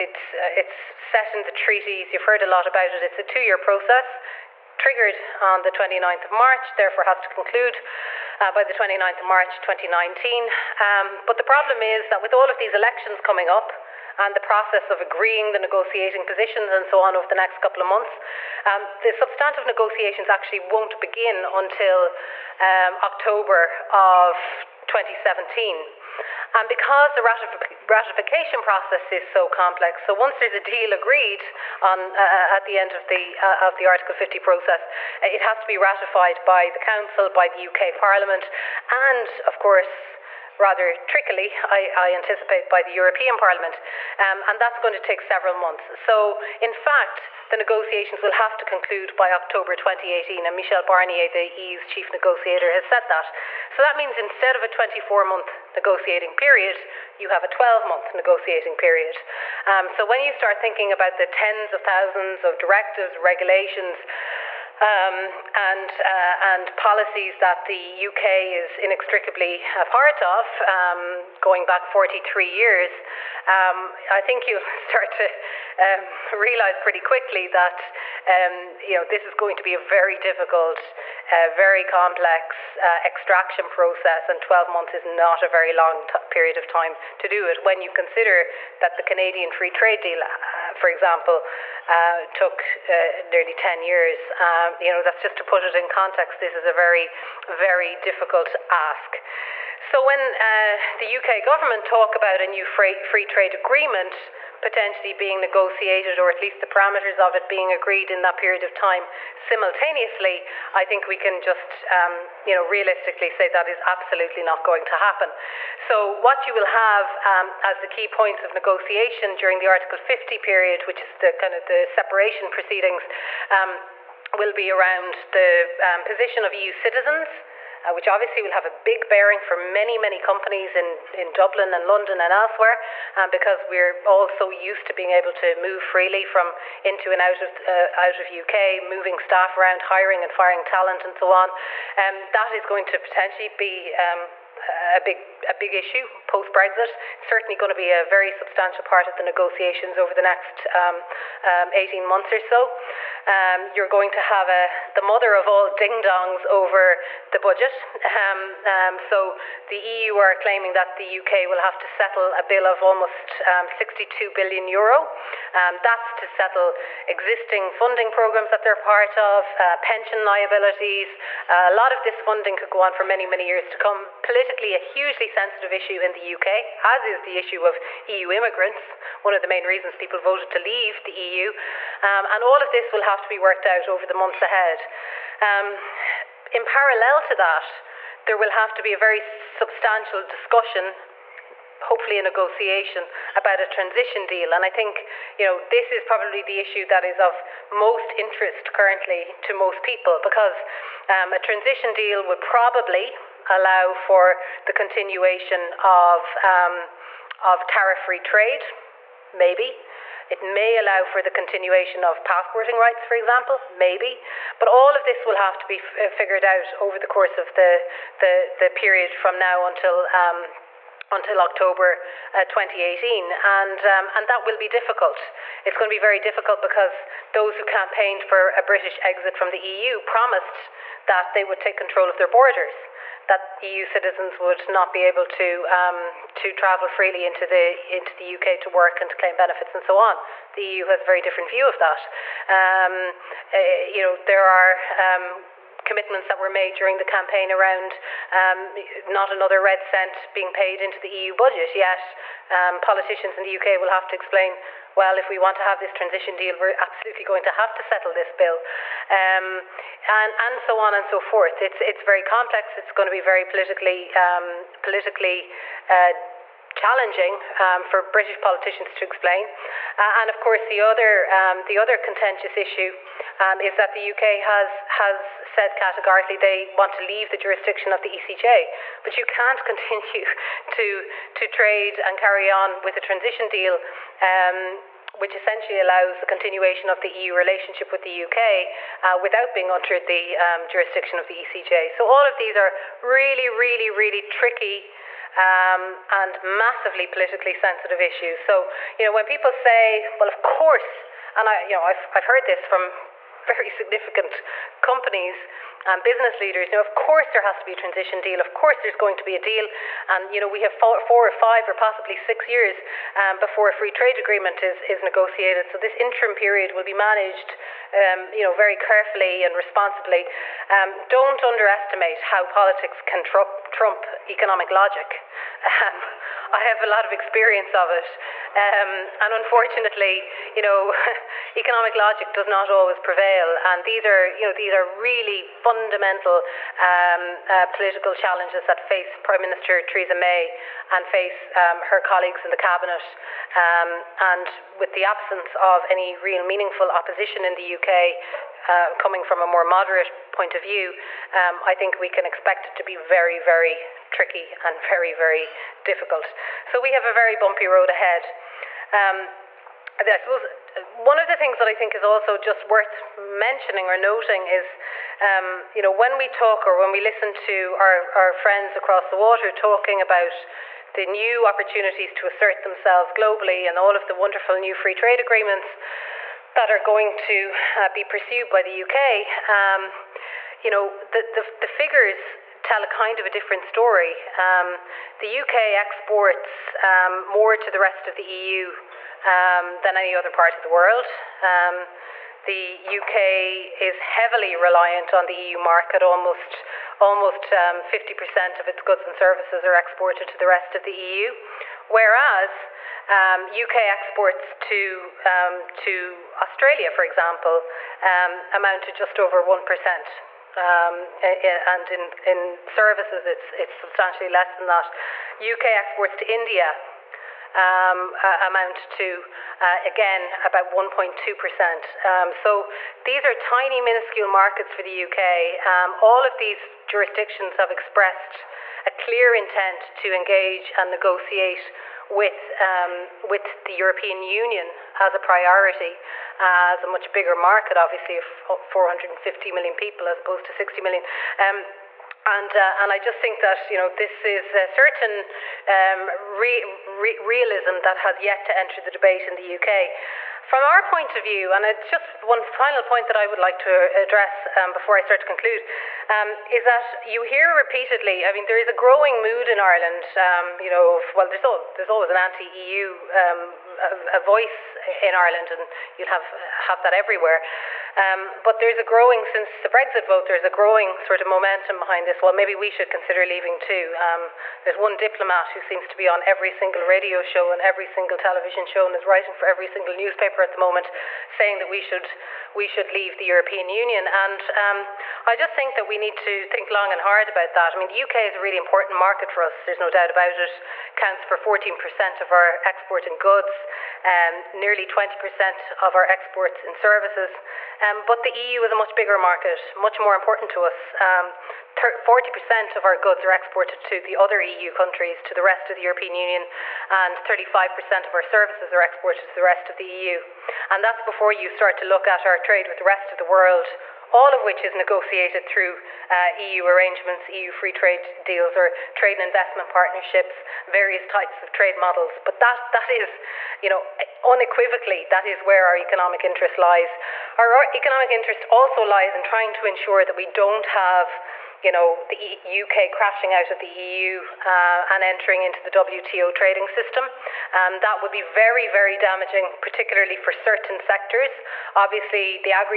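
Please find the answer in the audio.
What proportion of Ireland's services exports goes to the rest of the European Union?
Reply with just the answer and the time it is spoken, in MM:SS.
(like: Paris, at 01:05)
35%, at 08:27.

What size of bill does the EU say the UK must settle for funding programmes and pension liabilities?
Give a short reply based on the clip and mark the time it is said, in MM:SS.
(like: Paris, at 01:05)
62 billion euro, at 02:43.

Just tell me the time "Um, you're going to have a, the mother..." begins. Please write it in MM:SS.
02:33.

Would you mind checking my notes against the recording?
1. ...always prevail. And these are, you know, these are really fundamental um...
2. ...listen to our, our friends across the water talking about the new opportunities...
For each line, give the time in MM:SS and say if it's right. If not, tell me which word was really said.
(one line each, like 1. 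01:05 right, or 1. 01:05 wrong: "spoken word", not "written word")
1. 05:32 right
2. 06:07 right.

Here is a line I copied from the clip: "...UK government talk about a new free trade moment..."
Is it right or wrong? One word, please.
wrong.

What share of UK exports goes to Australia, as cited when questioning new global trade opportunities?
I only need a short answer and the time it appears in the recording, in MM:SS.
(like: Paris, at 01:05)
just over 1%, at 06:48.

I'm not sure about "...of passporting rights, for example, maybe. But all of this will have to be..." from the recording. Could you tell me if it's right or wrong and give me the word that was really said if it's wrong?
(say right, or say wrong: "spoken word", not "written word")
right.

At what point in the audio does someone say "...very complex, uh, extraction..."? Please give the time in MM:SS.
01:21.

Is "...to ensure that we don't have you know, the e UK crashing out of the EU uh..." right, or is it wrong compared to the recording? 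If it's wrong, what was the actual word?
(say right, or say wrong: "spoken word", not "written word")
right.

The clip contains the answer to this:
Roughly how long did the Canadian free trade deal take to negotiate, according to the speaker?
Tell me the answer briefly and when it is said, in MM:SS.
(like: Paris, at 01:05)
nearly 10 years, at 01:33.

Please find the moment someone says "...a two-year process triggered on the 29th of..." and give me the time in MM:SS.
00:03.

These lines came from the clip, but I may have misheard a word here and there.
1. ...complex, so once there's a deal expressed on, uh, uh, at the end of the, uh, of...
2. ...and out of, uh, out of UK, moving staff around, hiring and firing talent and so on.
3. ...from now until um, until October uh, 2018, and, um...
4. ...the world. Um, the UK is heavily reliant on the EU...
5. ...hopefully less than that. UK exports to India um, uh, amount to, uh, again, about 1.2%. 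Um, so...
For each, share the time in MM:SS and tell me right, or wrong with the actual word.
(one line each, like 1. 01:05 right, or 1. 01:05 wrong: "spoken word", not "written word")
1. 00:29 wrong: "agreed", not "expressed"
2. 02:17 right
3. 03:39 right
4. 06:30 right
5. 06:53 wrong: "substantially", not "hopefully".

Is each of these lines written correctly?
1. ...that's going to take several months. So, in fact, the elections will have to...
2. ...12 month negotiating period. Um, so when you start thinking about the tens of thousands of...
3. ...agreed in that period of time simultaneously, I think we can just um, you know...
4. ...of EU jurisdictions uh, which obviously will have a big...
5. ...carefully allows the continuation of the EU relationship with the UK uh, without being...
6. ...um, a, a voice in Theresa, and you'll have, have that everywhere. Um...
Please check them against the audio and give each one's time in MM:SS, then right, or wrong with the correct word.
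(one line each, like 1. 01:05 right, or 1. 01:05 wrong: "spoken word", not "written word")
1. 00:44 wrong: "negotiations", not "elections"
2. 00:57 right
3. 01:47 right
4. 02:06 wrong: "citizens", not "jurisdictions"
5. 04:45 wrong: "essentially", not "carefully"
6. 07:43 wrong: "Ireland", not "Theresa".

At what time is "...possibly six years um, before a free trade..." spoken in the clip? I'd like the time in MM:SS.
05:11.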